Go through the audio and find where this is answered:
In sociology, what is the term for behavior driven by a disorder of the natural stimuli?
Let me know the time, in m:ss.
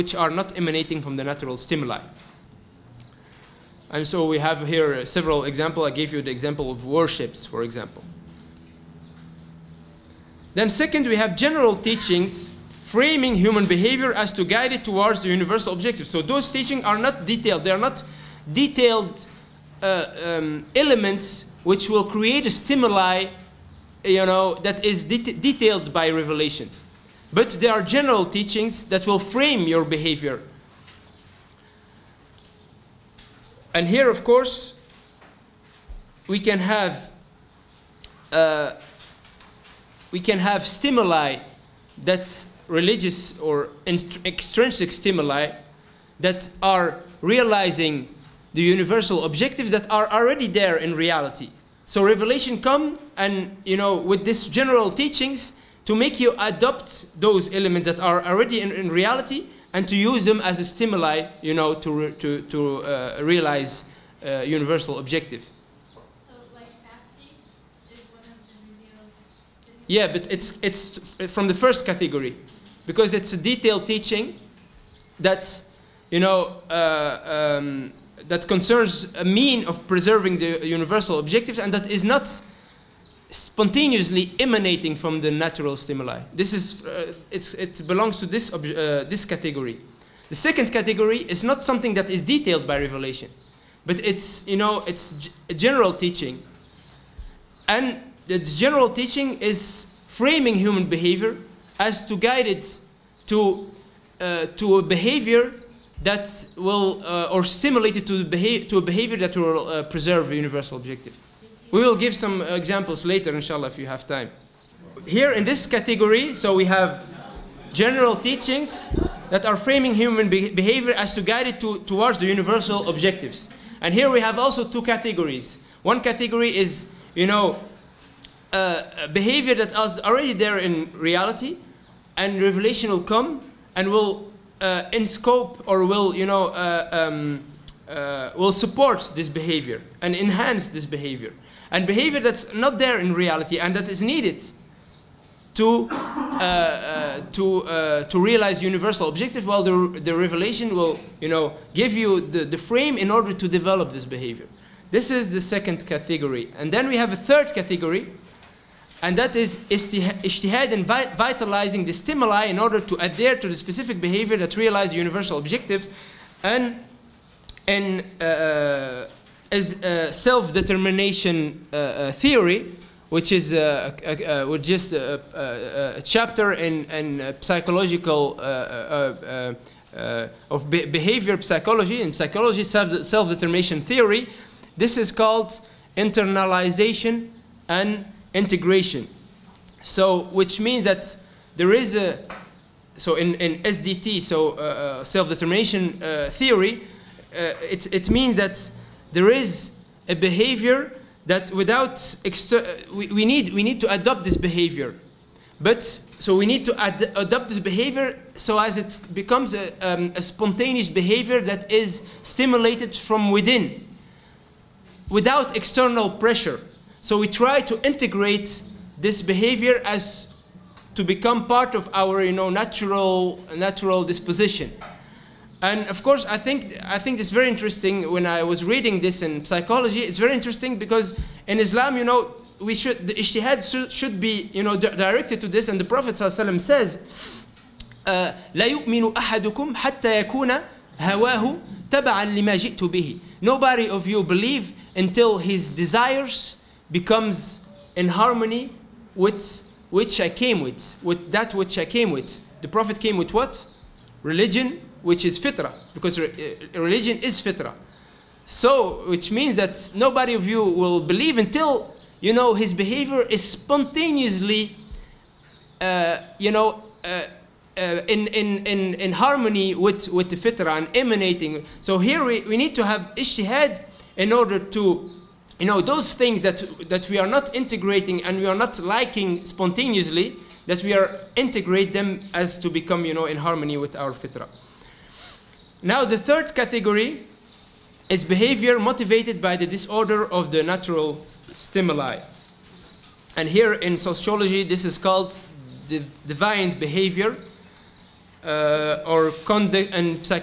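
4:56.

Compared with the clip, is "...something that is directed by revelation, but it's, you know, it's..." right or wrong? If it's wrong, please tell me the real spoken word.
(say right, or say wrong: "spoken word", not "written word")
wrong: "detailed", not "directed".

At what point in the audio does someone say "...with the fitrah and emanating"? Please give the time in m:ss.
4:30.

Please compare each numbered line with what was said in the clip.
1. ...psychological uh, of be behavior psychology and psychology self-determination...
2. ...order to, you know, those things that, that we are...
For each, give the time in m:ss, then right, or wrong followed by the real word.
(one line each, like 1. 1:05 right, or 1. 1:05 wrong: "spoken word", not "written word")
1. 2:57 right
2. 4:34 right.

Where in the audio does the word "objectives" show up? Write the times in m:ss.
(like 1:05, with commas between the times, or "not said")
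0:15, 0:49, 1:04, 1:21, 1:50, 2:02, 2:29, 2:45.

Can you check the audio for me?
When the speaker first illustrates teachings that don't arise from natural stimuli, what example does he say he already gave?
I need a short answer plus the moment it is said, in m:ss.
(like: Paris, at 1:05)
worships, at 0:06.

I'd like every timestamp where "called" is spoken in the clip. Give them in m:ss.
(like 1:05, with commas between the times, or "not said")
3:05, 4:54.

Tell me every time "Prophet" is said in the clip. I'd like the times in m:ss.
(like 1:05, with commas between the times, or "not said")
3:55, 4:12.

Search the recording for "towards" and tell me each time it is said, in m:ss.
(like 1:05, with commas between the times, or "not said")
0:14, 2:01.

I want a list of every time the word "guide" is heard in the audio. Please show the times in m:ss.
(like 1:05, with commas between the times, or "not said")
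0:14, 1:42, 2:01.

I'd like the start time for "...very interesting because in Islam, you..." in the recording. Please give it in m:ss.
3:50.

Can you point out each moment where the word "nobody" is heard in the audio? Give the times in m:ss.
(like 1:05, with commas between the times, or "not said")
4:03, 4:19.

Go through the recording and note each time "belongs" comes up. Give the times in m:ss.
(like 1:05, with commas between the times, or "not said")
1:27.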